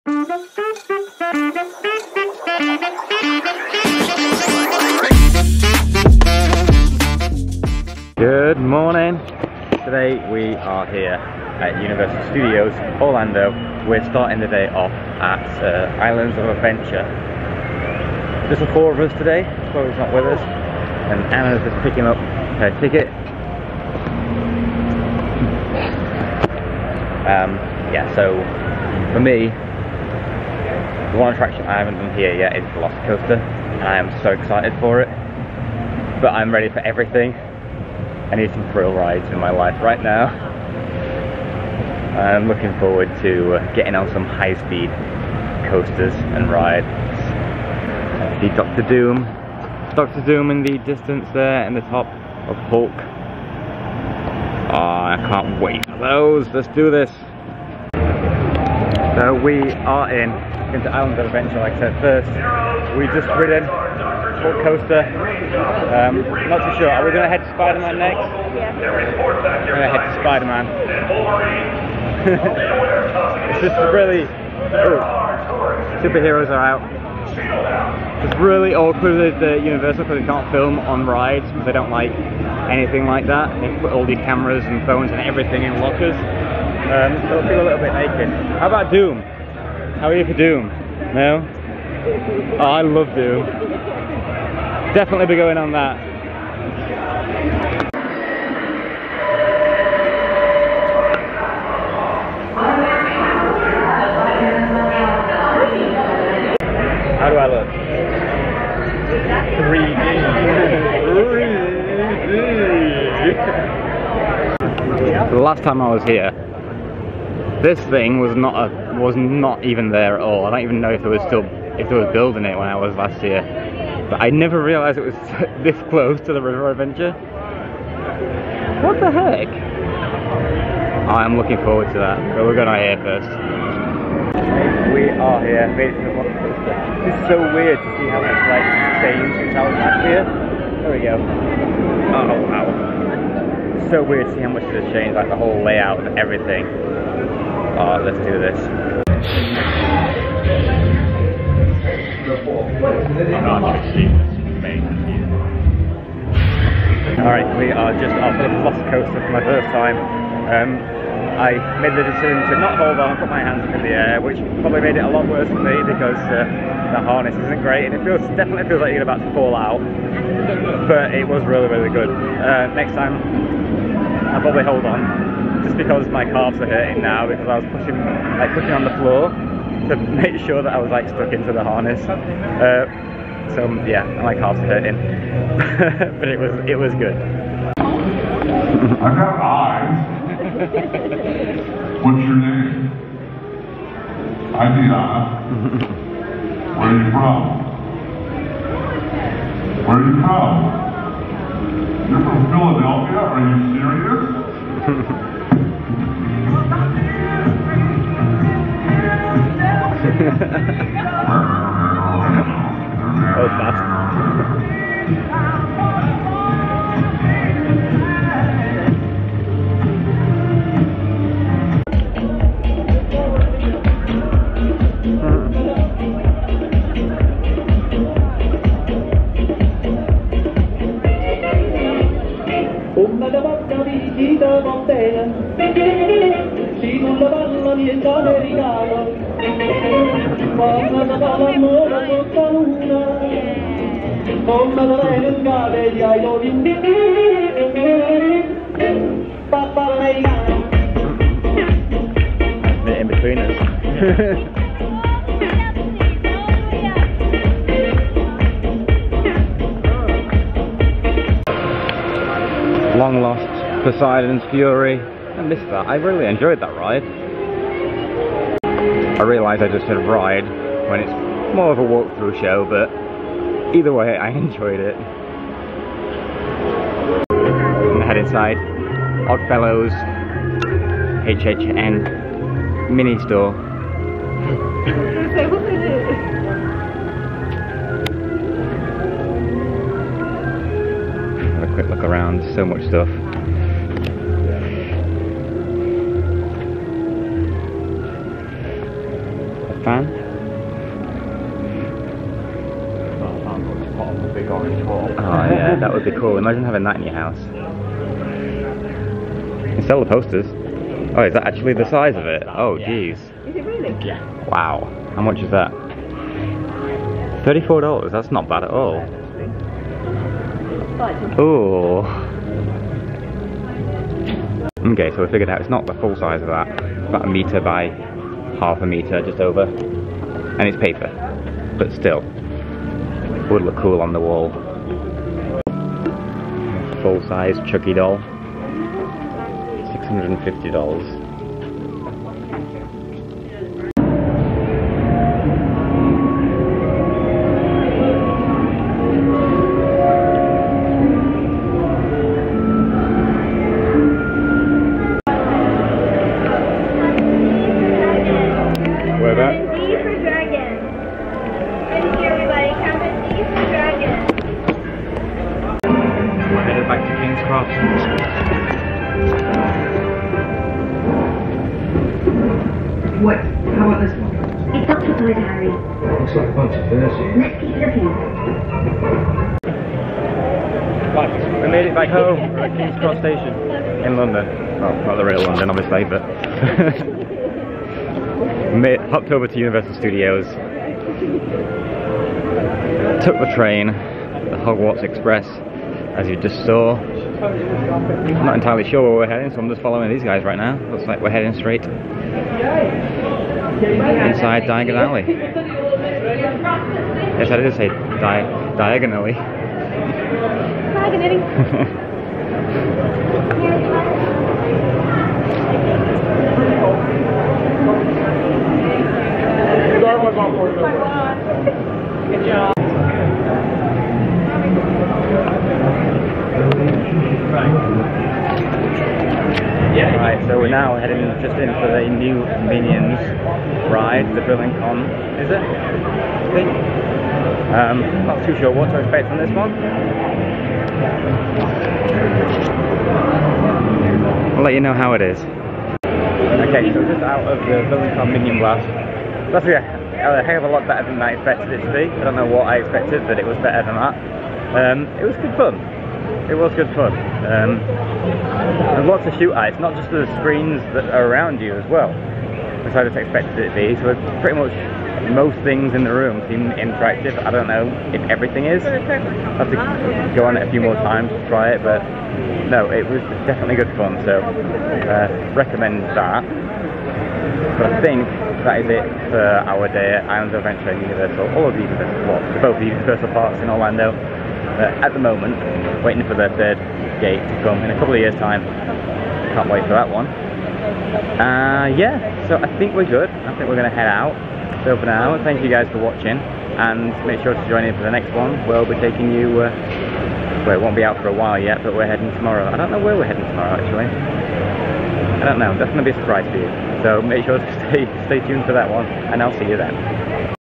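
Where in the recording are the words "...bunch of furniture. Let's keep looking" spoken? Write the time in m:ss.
6:16.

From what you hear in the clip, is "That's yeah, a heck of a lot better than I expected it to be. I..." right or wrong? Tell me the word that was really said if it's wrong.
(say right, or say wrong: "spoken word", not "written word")
right.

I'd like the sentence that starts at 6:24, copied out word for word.
Well, not the real London, obviously, but...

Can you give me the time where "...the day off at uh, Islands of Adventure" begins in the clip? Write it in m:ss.
0:14.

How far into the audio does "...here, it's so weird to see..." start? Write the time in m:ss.
2:15.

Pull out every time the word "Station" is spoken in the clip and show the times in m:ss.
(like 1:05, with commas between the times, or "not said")
6:23.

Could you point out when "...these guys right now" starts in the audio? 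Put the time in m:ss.
6:40.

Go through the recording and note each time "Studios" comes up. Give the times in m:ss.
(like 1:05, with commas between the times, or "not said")
0:12, 6:29.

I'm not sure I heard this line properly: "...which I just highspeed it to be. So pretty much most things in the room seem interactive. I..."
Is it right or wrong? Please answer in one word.
wrong.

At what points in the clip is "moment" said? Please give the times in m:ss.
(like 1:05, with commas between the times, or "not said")
8:05.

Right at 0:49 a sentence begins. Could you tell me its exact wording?
Doctor Doom in the distance there in the top of Hulk.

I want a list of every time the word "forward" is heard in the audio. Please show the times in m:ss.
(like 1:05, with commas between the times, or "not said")
0:42, 2:11.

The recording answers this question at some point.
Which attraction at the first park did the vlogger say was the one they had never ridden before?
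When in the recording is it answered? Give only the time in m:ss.
0:32.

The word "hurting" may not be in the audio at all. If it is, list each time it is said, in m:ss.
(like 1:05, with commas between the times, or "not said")
2:56, 3:04.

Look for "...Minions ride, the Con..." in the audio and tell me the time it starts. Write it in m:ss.
7:12.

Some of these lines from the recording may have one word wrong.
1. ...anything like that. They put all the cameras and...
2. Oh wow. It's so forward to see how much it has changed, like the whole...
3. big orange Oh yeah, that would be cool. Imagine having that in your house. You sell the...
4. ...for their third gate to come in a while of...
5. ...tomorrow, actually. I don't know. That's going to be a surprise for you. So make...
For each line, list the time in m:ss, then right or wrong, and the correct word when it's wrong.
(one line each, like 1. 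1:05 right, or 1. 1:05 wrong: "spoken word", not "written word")
1. 1:22 right
2. 2:22 wrong: "weird", not "forward"
3. 5:04 right
4. 8:06 wrong: "couple", not "while"
5. 8:23 right.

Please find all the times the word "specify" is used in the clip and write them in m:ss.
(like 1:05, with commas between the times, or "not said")
not said.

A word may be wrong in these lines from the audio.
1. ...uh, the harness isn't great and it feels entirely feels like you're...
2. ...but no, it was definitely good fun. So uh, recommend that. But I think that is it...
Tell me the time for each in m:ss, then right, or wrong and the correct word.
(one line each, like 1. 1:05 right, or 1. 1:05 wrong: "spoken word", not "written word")
1. 2:46 wrong: "definitely", not "entirely"
2. 7:51 right.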